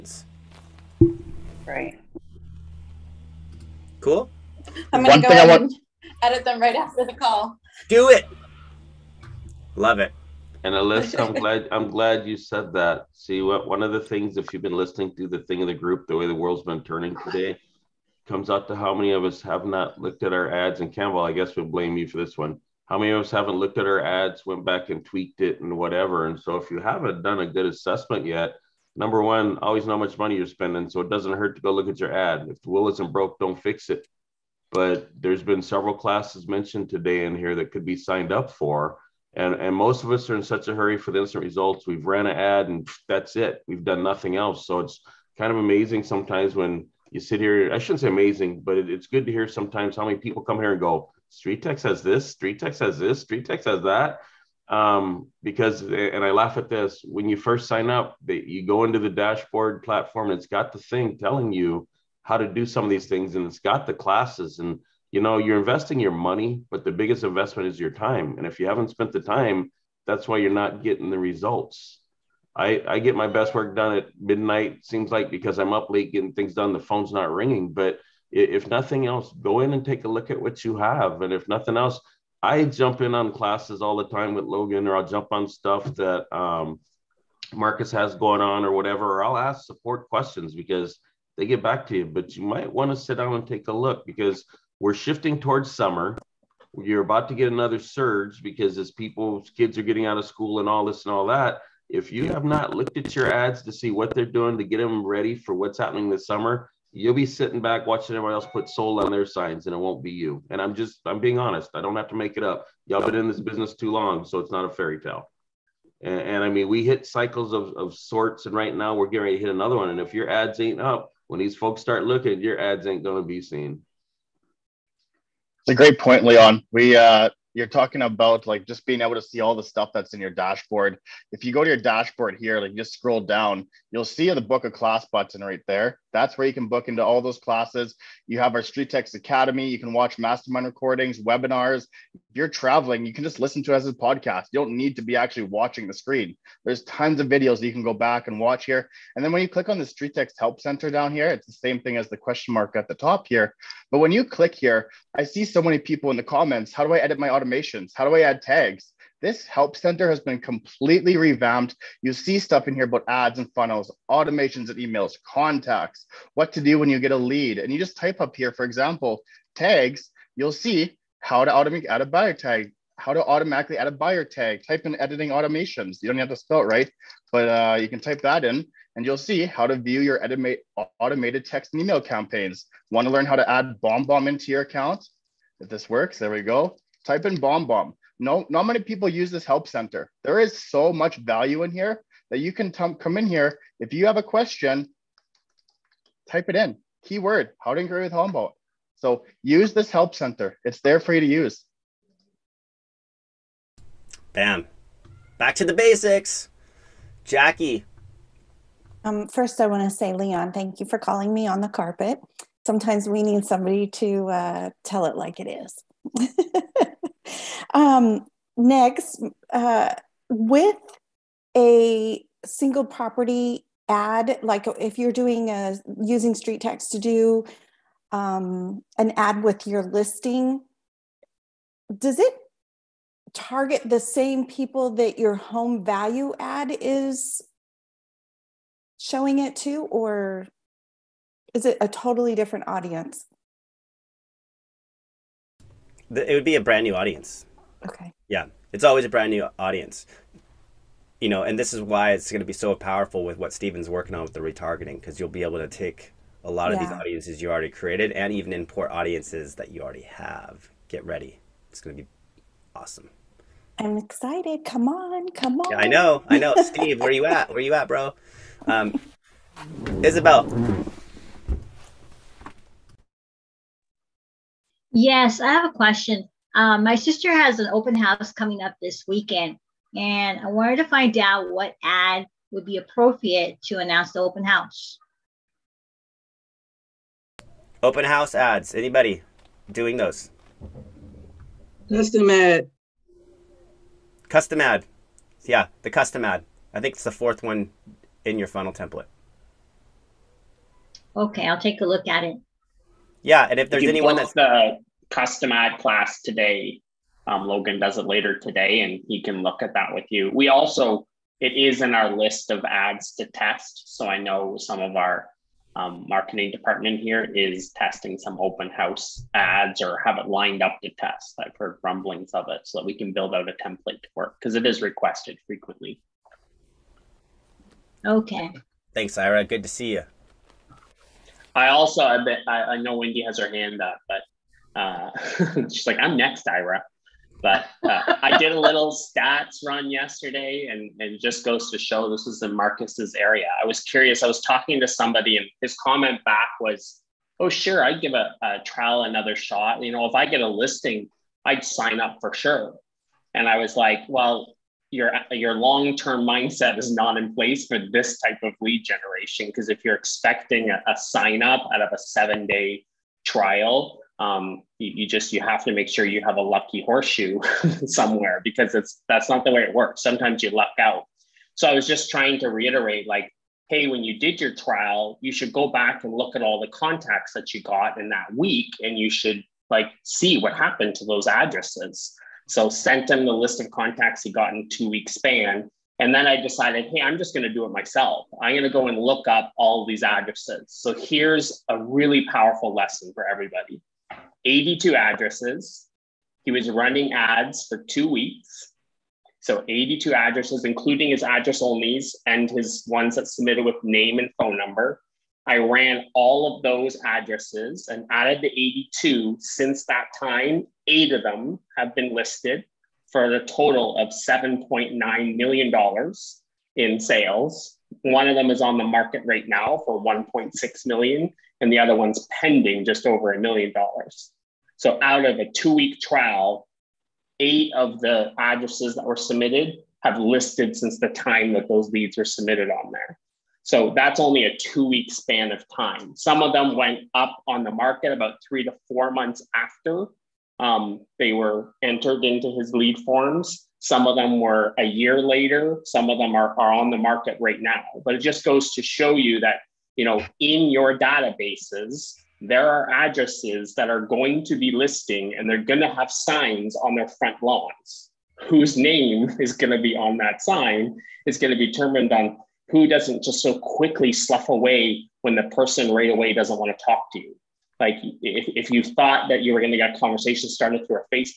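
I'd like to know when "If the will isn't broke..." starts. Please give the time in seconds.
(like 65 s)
32 s.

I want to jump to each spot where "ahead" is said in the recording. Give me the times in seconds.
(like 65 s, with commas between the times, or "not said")
5 s.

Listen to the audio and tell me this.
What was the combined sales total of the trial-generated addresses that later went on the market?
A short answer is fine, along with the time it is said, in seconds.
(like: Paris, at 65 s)
$7.9 million, at 414 s.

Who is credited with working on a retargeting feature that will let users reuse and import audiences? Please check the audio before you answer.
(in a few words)
Steven.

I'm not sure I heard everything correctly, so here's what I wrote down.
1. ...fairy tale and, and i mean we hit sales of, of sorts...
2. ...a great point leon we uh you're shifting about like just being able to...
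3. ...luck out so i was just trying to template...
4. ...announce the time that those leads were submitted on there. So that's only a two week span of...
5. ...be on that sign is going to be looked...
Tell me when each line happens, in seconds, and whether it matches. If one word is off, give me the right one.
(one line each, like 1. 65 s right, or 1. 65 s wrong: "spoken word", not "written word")
1. 114 s wrong: "cycles", not "sales"
2. 125 s wrong: "talking", not "shifting"
3. 370 s wrong: "reiterate", not "template"
4. 430 s wrong: "since", not "announce"
5. 459 s wrong: "determined", not "looked".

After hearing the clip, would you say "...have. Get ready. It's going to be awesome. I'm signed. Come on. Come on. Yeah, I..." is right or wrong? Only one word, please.
wrong.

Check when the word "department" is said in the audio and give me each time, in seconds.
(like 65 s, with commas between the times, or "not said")
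316 s.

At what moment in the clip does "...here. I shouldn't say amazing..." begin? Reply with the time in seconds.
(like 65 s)
47 s.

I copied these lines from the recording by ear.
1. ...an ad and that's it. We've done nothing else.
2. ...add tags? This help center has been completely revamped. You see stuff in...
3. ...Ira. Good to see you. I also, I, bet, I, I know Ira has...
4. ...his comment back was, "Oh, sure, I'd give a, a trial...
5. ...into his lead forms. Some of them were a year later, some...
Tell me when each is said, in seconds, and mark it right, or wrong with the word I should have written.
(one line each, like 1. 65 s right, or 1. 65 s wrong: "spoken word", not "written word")
1. 42 s right
2. 158 s right
3. 329 s wrong: "Wendy", not "Ira"
4. 345 s right
5. 442 s right.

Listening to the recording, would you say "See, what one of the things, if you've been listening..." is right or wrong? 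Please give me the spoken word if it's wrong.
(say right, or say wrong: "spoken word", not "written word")
right.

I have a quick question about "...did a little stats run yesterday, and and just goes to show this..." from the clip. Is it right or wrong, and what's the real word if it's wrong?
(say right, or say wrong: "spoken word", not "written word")
right.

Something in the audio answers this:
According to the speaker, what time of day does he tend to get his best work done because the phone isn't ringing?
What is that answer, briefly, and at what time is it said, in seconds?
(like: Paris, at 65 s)
Midnight, at 74 s.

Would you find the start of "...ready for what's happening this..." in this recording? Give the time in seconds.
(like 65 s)
105 s.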